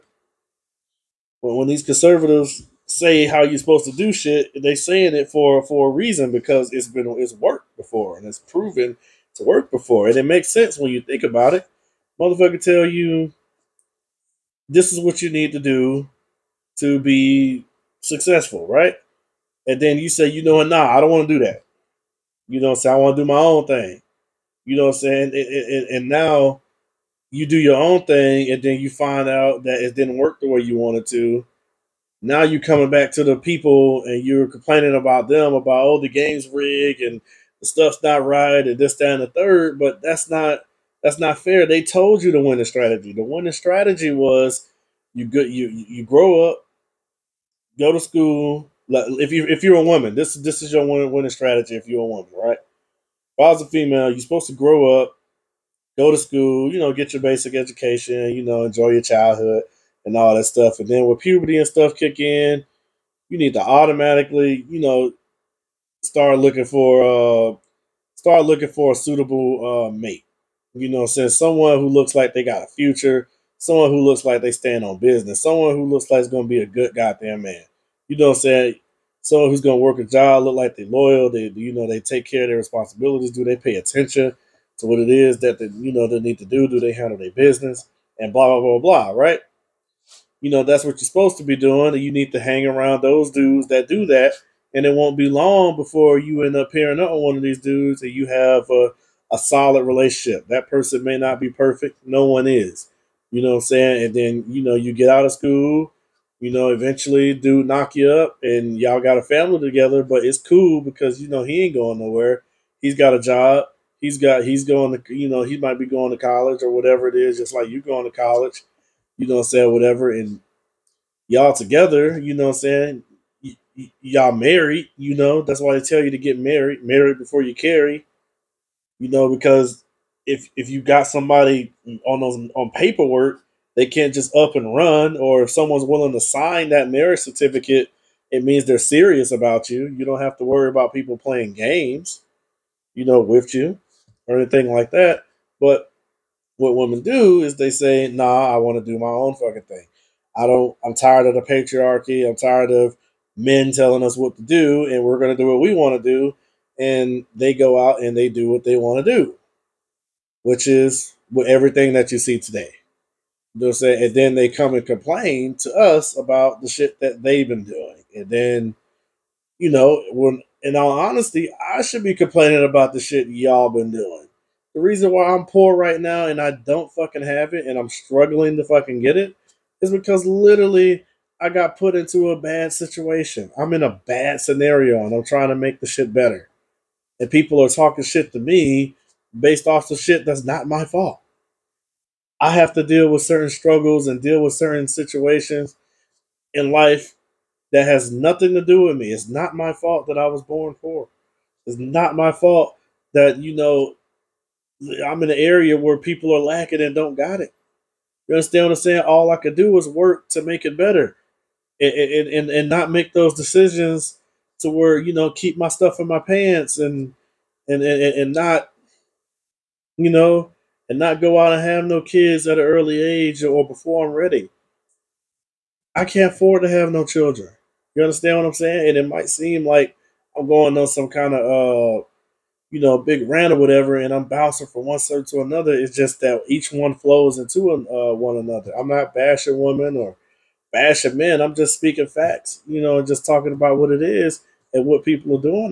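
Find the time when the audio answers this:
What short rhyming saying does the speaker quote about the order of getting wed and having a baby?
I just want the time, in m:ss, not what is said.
2:06.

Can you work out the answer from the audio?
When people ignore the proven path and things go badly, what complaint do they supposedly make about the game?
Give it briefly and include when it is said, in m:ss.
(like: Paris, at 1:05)
the game's rigged, at 0:35.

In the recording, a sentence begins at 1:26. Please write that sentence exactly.
Do they handle their business and blah blah blah blah, right?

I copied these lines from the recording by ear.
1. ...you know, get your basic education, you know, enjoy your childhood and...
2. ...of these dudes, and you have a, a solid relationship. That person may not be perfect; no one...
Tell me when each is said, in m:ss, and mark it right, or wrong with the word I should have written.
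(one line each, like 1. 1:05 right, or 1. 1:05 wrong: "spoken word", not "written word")
1. 0:56 right
2. 1:37 right.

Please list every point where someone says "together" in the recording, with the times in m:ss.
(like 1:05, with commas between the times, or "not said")
1:49, 2:01.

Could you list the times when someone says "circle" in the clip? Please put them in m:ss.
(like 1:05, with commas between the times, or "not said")
3:54.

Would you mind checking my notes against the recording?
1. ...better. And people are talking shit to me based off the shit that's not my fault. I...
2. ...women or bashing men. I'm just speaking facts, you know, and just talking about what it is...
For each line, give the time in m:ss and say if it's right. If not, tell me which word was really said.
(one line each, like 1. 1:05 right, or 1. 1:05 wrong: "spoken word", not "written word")
1. 3:06 right
2. 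3:59 right.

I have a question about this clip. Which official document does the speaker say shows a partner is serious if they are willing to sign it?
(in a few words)
marriage certificate.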